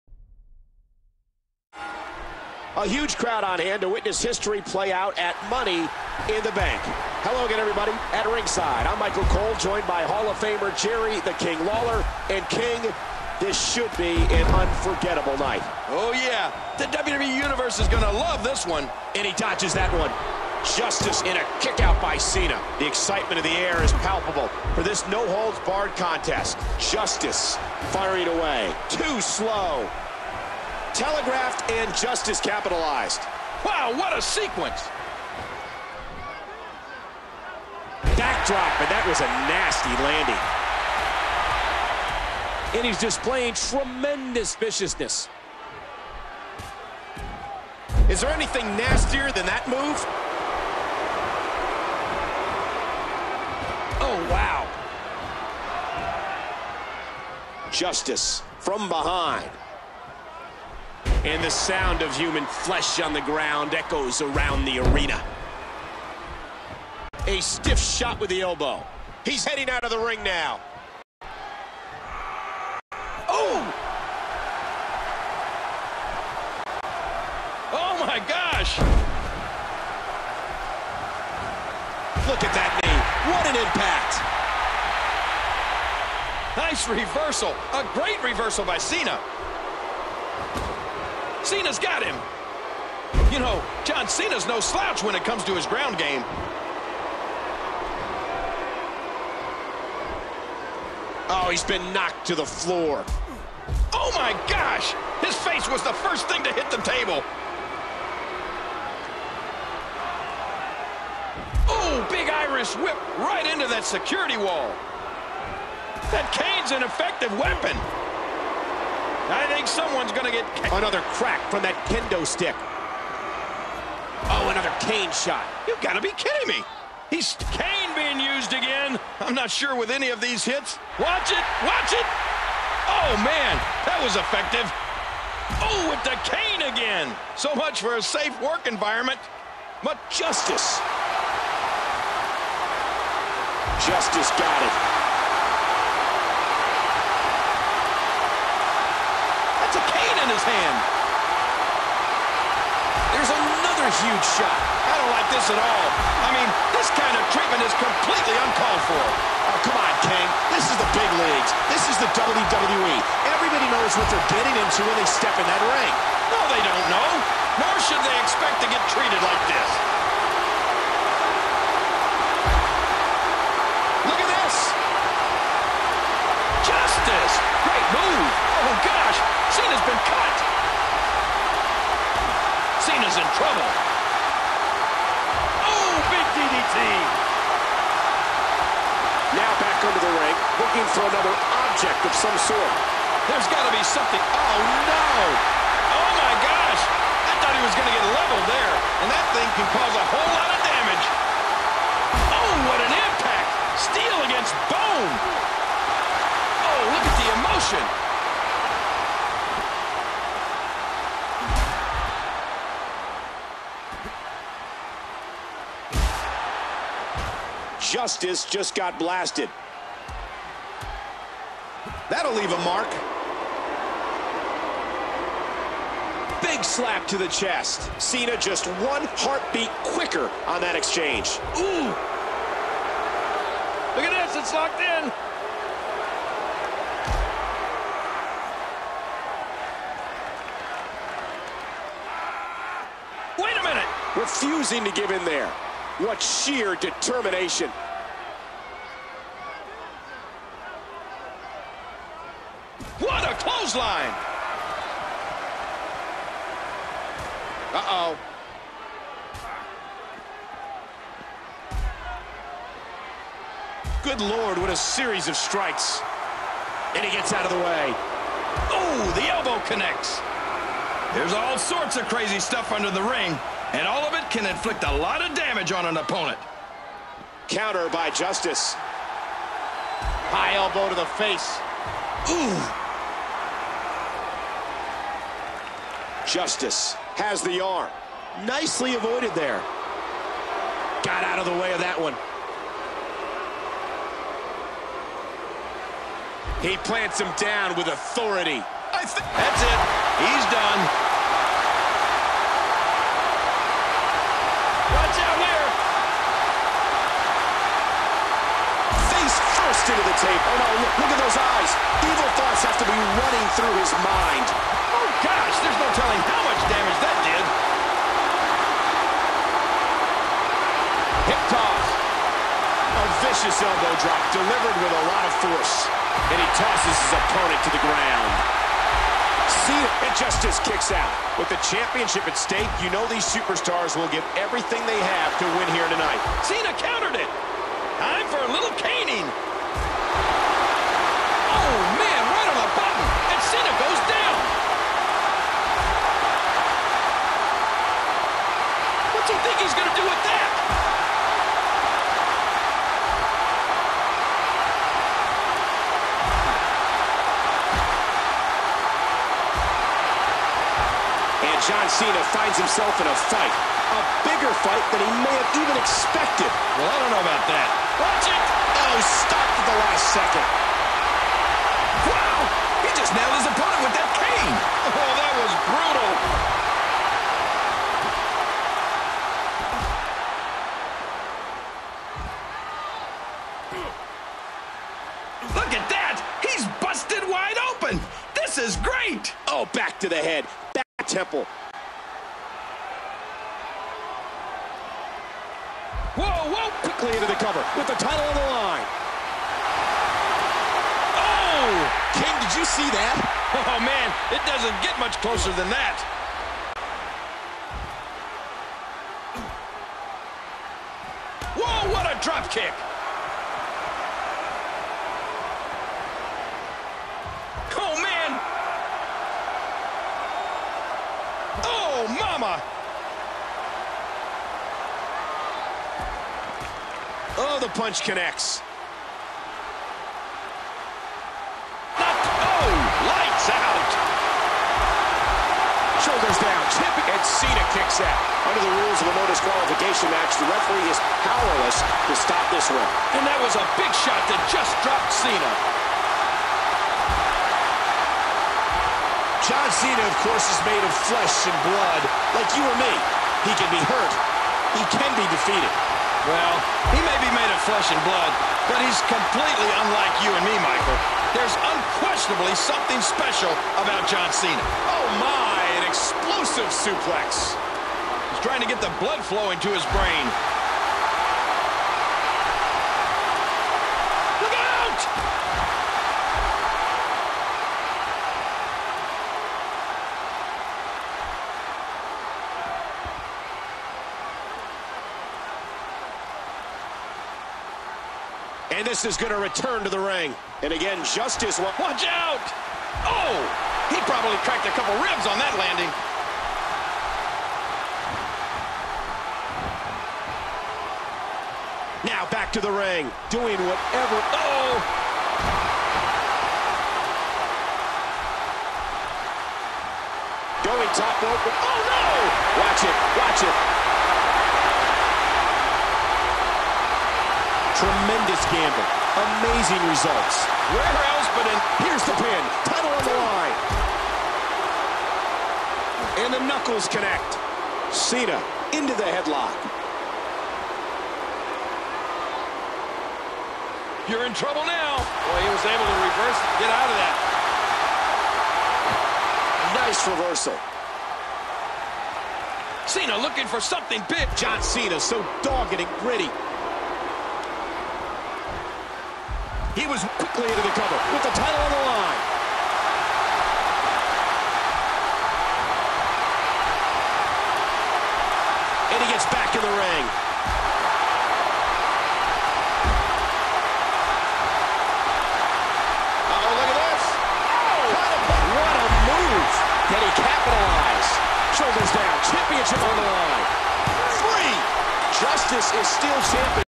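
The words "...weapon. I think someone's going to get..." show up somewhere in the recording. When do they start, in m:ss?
1:57.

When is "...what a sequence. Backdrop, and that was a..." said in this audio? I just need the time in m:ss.
0:33.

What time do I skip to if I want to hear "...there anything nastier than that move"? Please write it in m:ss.
0:48.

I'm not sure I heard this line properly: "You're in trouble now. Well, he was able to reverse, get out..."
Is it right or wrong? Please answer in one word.
right.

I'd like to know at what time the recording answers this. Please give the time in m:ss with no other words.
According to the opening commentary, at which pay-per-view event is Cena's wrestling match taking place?
0:05.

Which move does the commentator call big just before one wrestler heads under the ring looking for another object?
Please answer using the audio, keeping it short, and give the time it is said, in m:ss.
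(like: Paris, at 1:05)
DDT, at 3:06.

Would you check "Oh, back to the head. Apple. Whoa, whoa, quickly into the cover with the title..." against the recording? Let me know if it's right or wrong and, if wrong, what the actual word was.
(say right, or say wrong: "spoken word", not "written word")
right.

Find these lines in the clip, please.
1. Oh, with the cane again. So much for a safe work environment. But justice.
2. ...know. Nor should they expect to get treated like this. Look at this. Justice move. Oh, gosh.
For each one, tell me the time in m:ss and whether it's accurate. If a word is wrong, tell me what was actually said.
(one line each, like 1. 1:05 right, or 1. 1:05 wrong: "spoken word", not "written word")
1. 2:15 right
2. 2:46 right.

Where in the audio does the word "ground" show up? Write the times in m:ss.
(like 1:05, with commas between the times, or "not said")
1:03, 1:35, 5:27.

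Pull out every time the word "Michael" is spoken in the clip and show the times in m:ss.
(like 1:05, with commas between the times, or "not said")
0:08, 7:40.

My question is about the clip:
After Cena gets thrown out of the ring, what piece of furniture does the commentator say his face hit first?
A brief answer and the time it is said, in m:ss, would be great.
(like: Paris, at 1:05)
The table, at 1:46.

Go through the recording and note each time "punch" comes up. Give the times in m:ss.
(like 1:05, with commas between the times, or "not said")
7:07.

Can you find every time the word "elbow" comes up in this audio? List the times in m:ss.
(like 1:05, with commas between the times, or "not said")
1:08, 4:29, 4:40, 5:23.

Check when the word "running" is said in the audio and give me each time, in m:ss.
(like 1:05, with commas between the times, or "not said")
5:13.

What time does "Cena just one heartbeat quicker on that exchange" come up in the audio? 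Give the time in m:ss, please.
3:48.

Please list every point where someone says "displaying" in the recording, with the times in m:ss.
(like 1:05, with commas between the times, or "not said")
0:42.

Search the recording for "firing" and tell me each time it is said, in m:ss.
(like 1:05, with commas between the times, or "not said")
0:27.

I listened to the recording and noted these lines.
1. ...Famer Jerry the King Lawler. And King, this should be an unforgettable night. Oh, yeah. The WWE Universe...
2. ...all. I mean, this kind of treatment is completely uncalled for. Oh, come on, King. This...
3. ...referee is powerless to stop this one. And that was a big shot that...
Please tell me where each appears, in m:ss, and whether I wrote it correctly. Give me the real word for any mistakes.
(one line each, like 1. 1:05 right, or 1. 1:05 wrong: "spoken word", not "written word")
1. 0:10 right
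2. 2:35 right
3. 7:20 right.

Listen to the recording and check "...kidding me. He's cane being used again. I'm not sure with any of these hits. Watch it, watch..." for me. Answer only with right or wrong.
right.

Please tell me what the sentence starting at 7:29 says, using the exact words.
John Cena, of course, is made of flesh and blood, like you or me.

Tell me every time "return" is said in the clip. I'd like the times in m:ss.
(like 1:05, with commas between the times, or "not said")
8:09.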